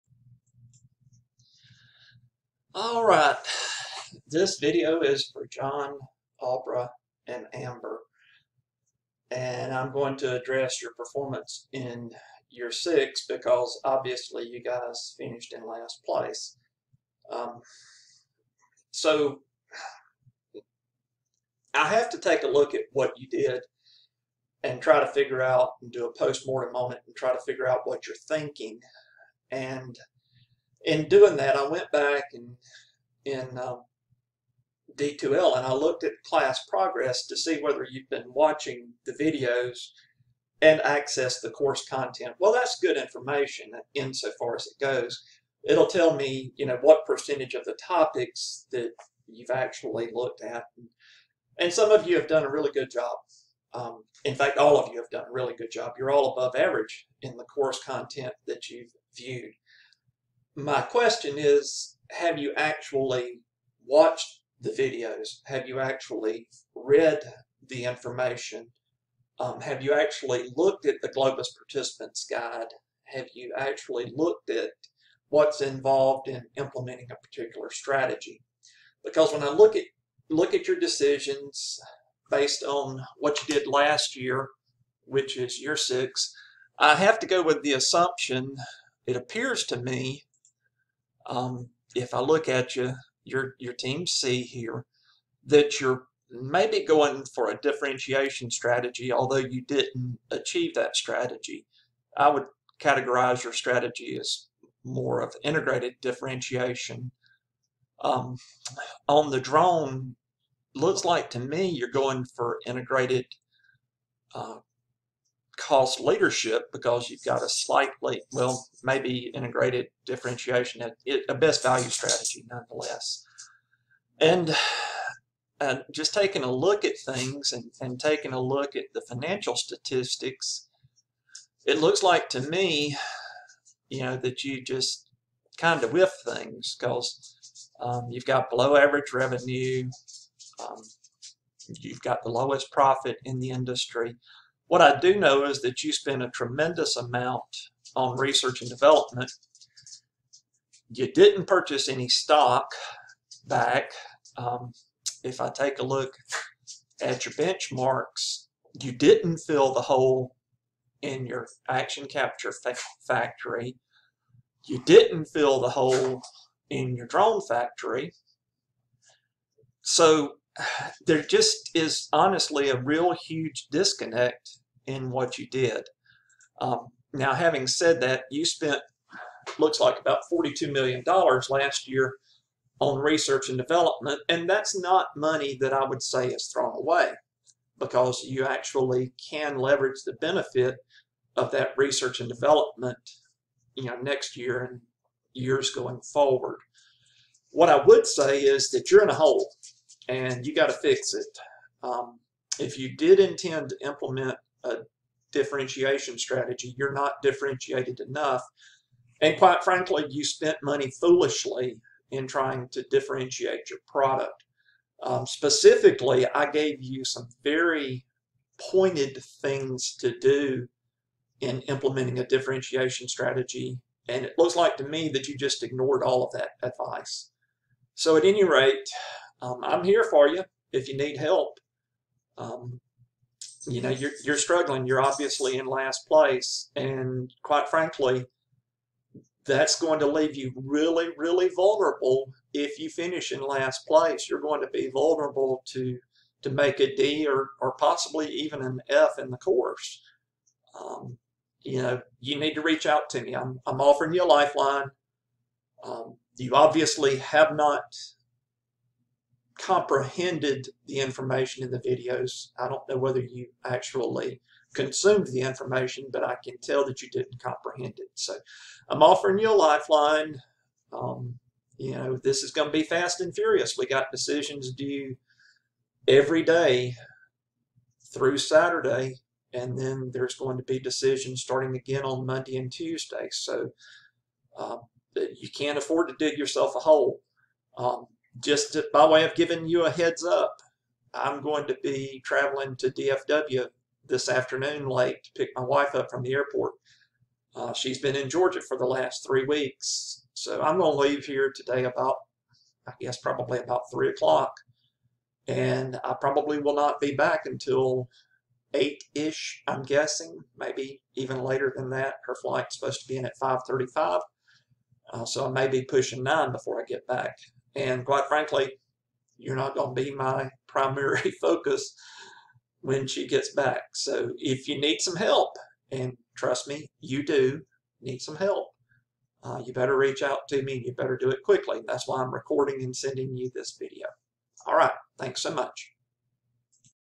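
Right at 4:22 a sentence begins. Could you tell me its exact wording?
I don't know whether you actually consumed the information, but I can tell that you didn't comprehend it.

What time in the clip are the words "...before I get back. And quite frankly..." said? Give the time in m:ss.
5:16.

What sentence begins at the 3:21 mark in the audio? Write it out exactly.
Um, if you did intend to implement a differentiation strategy.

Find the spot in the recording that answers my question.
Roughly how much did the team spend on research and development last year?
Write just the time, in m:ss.
3:00.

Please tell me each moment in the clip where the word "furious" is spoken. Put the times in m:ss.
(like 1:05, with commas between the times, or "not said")
4:33.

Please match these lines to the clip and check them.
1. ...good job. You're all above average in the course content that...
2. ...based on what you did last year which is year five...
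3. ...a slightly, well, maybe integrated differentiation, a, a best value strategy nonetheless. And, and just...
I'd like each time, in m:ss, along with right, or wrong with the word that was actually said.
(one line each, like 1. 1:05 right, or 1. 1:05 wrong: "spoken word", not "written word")
1. 0:55 right
2. 1:22 wrong: "six", not "five"
3. 1:57 right.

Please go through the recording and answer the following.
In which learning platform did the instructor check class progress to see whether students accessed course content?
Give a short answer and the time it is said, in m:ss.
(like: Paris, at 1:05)
D2L, at 0:34.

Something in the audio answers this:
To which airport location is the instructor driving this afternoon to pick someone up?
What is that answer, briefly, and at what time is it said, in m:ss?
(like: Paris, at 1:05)
DFW, at 4:52.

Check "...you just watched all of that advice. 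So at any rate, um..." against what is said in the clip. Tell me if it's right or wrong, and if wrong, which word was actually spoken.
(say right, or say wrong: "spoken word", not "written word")
wrong: "ignored", not "watched".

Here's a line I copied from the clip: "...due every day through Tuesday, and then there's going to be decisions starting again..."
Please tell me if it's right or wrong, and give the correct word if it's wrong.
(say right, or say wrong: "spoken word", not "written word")
wrong: "Saturday", not "Tuesday".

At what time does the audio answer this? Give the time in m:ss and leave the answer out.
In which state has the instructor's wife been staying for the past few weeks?
4:58.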